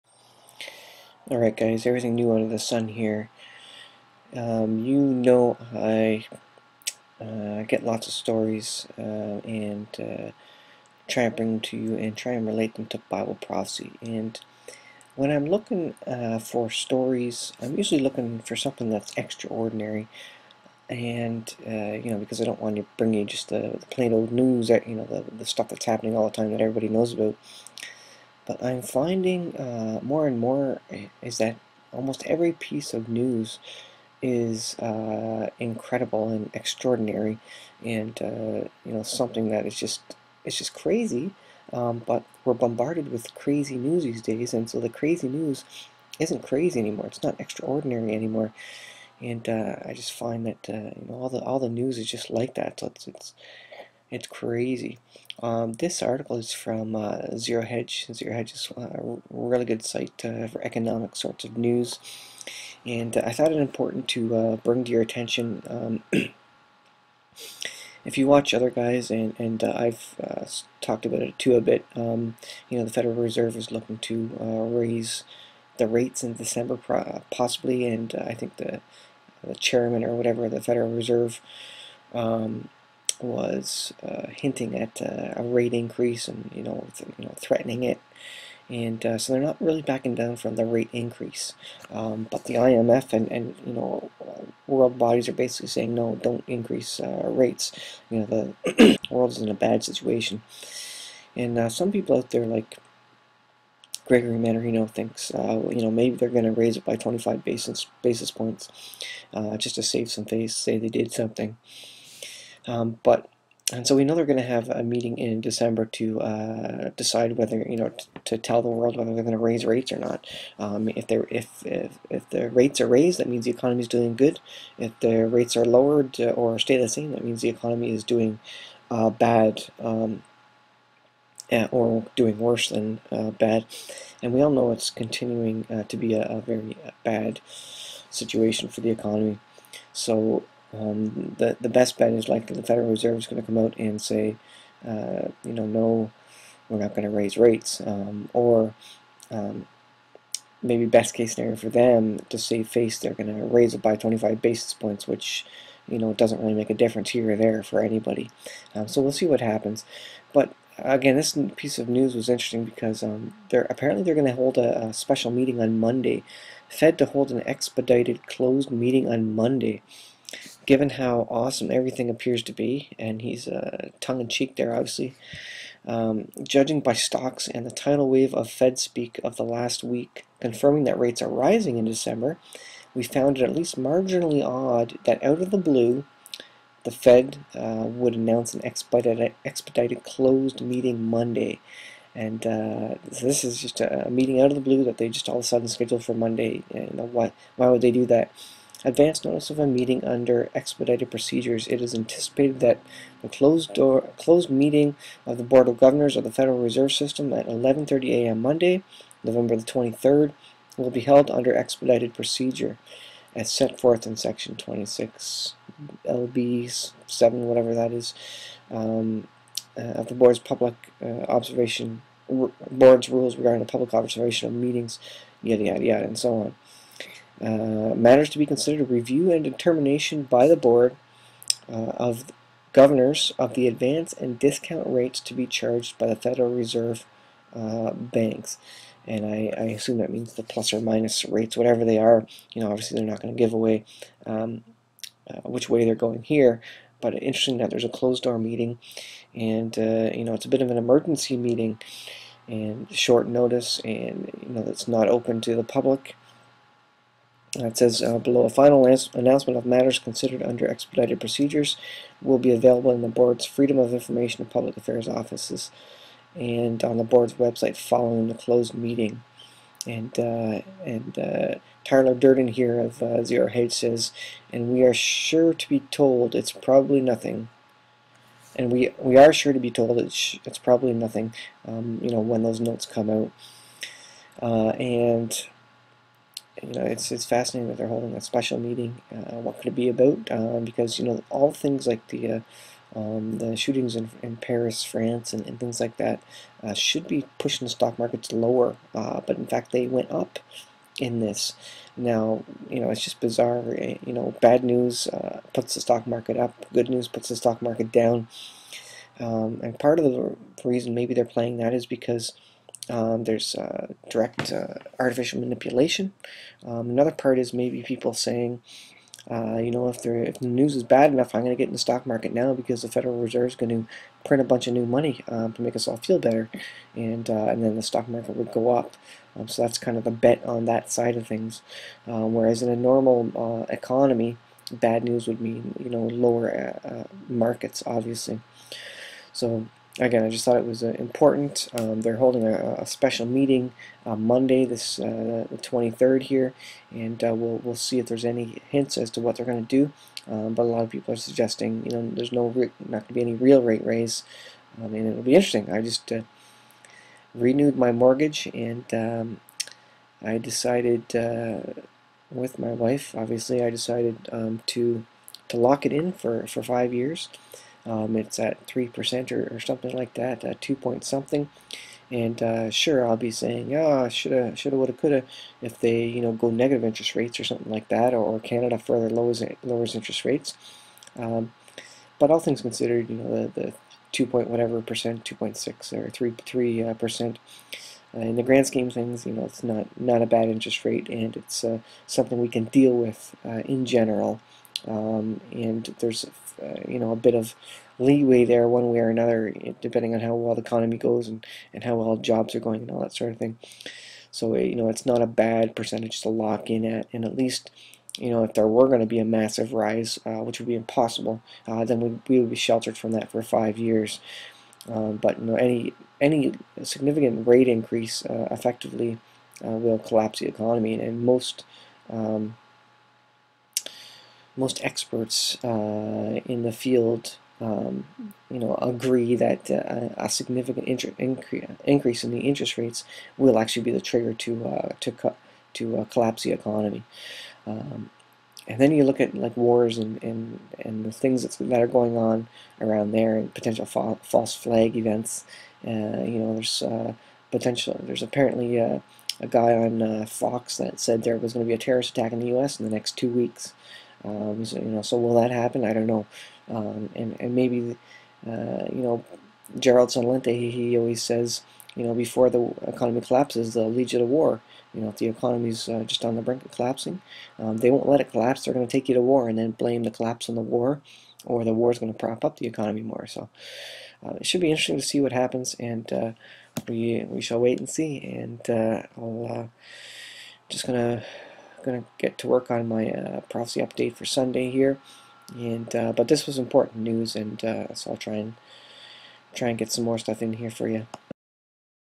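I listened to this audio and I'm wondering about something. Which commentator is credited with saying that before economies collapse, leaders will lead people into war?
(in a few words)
Gerald Celente.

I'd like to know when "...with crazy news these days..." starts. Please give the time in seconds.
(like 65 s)
43 s.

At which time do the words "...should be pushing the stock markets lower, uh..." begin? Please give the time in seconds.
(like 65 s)
296 s.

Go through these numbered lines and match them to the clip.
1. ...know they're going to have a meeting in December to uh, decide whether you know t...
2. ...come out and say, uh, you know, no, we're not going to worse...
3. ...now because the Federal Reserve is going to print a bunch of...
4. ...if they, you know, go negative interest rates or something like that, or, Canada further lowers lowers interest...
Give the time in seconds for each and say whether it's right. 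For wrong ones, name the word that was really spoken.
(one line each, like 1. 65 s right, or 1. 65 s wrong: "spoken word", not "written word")
1. 114 s right
2. 143 s wrong: "raise", not "worse"
3. 322 s right
4. 375 s right.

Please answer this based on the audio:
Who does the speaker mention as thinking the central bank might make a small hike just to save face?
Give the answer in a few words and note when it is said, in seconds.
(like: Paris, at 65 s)
Gregory Manorino, at 104 s.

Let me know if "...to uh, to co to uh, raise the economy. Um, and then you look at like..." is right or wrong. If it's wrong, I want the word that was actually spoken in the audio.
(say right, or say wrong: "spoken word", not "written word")
wrong: "collapse", not "raise".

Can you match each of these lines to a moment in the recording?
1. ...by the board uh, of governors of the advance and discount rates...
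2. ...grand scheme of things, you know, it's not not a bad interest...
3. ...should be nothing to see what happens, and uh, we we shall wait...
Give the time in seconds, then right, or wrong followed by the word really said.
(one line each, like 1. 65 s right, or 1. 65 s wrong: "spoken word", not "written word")
1. 230 s right
2. 388 s right
3. 474 s wrong: "interesting", not "nothing".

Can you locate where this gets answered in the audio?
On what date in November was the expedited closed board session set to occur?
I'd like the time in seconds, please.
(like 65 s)
209 s.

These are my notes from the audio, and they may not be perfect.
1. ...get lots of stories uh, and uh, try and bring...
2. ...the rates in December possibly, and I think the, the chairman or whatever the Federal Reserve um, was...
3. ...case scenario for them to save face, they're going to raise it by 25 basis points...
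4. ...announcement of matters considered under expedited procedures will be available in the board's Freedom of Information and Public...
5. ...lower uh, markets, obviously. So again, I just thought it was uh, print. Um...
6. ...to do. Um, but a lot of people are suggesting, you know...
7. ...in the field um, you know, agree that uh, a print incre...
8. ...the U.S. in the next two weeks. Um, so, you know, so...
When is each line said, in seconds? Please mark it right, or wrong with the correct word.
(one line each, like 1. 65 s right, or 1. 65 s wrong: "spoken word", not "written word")
1. 7 s right
2. 75 s right
3. 151 s right
4. 258 s right
5. 336 s wrong: "important", not "print"
6. 349 s right
7. 426 s wrong: "significant", not "print"
8. 452 s right.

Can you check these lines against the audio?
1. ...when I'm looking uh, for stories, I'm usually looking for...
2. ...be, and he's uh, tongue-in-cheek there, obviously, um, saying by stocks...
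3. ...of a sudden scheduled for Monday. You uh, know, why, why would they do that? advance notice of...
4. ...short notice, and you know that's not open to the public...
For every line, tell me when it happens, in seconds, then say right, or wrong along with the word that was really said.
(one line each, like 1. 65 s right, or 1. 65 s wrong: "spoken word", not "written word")
1. 15 s right
2. 172 s wrong: "judging", not "saying"
3. 195 s right
4. 252 s right.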